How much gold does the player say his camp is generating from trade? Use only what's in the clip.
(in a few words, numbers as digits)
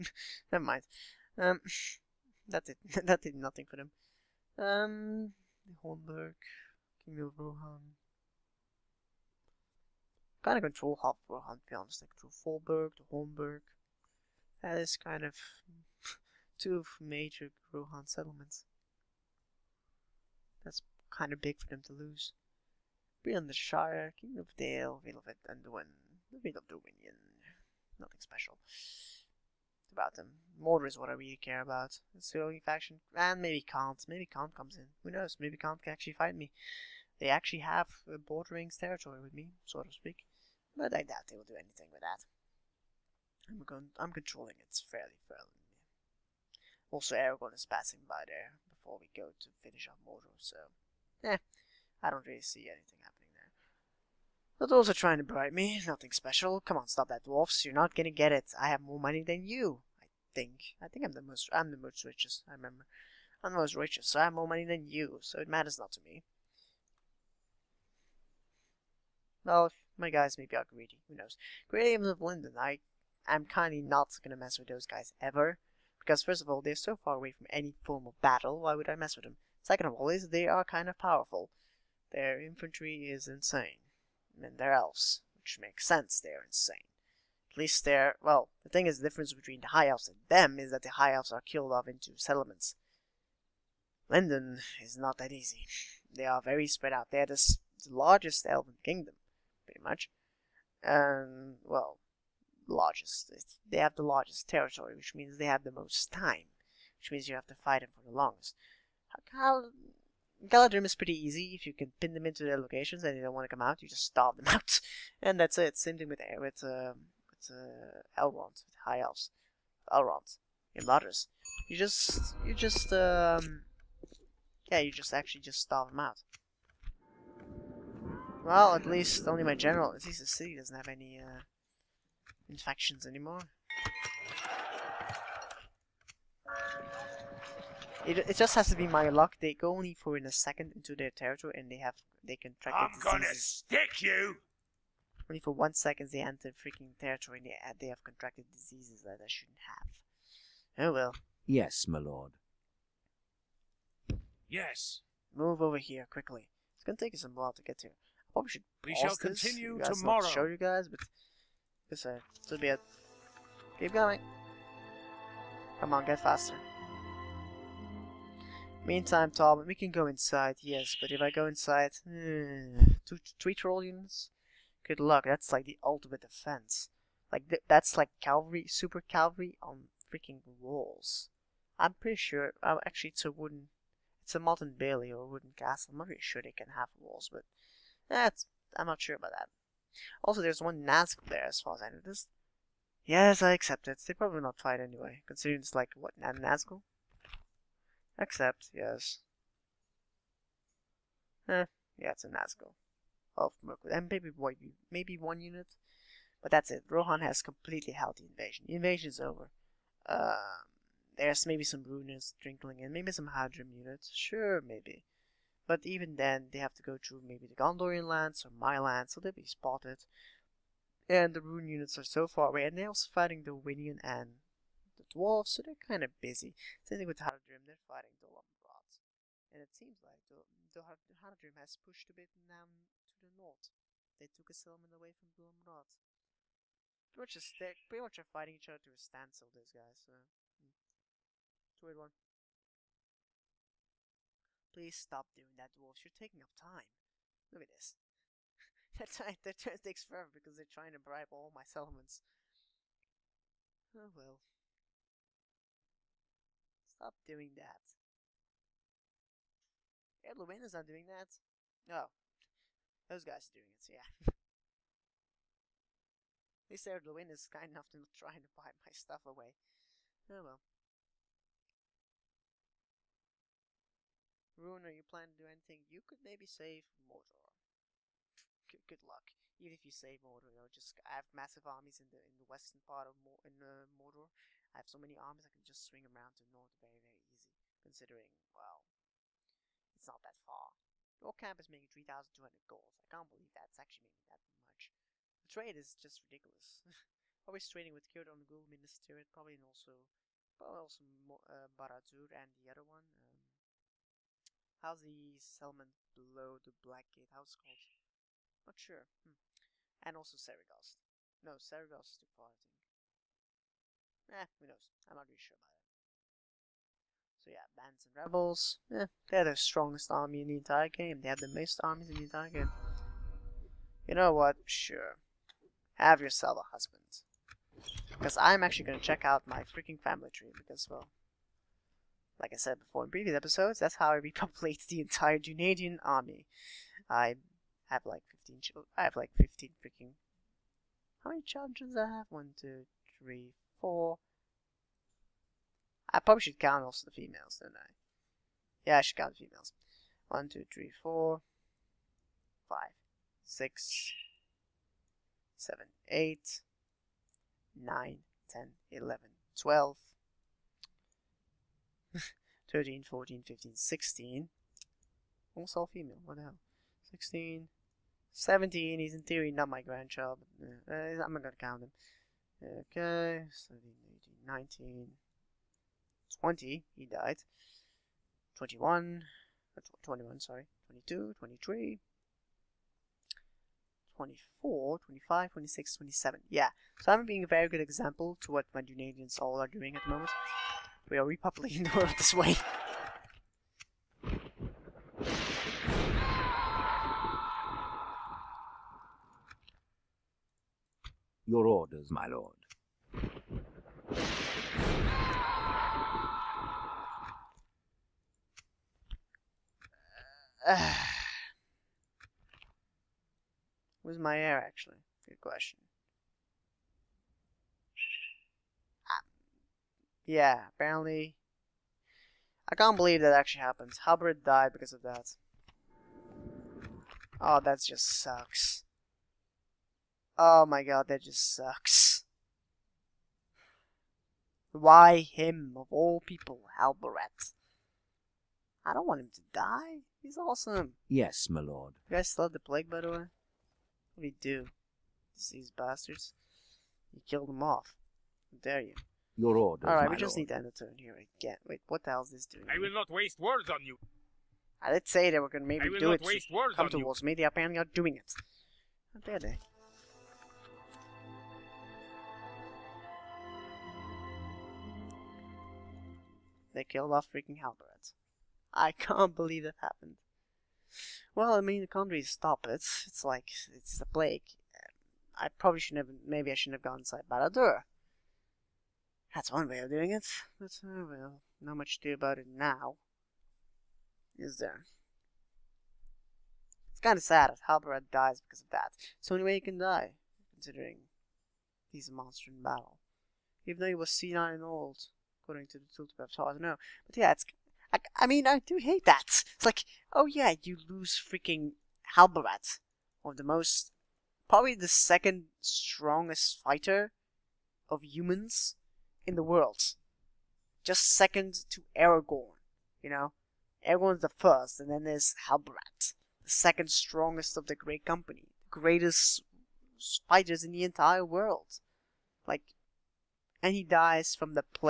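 3,200 gold.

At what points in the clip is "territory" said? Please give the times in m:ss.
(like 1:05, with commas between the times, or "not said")
0:38, 1:44, 2:21, 2:26.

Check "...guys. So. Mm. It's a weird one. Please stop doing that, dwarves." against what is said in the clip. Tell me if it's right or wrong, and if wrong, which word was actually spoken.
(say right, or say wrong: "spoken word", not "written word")
right.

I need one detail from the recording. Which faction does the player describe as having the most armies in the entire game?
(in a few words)
rebels.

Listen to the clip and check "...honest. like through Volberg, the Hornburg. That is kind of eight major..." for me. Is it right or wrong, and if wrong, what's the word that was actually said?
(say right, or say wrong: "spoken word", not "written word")
wrong: "two", not "eight".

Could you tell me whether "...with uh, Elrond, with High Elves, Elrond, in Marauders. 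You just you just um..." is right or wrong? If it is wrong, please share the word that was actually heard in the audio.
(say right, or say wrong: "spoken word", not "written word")
right.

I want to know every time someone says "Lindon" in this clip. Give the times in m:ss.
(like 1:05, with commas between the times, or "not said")
1:12, 1:34.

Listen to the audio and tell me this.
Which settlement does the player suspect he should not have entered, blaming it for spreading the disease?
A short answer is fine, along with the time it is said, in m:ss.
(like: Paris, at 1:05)
Barad-dur, at 7:57.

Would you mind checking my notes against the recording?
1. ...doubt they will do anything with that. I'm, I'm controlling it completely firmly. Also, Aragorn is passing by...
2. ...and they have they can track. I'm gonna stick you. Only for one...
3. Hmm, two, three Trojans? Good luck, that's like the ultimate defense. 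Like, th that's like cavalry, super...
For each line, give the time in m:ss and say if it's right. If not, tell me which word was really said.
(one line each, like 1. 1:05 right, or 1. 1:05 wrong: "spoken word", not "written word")
1. 0:41 wrong: "fairly", not "completely"
2. 2:21 right
3. 2:52 right.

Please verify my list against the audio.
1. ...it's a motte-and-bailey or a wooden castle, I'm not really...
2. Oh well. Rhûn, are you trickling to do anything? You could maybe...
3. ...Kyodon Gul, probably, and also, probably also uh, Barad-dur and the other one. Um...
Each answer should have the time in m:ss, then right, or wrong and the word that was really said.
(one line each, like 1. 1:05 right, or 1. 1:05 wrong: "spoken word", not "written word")
1. 3:04 right
2. 4:30 wrong: "planning", not "trickling"
3. 4:58 right.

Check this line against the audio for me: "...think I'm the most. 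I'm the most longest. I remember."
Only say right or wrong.
wrong.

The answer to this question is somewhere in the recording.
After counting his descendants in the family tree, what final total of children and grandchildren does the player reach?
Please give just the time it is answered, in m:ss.
6:25.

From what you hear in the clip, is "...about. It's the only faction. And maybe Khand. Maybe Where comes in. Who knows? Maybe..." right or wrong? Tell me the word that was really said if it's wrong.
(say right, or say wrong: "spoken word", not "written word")
wrong: "Khand", not "Where".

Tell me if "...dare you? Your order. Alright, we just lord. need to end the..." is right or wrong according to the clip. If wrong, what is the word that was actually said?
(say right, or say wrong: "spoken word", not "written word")
right.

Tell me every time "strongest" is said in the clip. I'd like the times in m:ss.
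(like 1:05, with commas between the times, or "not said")
5:19, 8:25, 8:36.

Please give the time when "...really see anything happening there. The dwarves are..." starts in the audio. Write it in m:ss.
0:52.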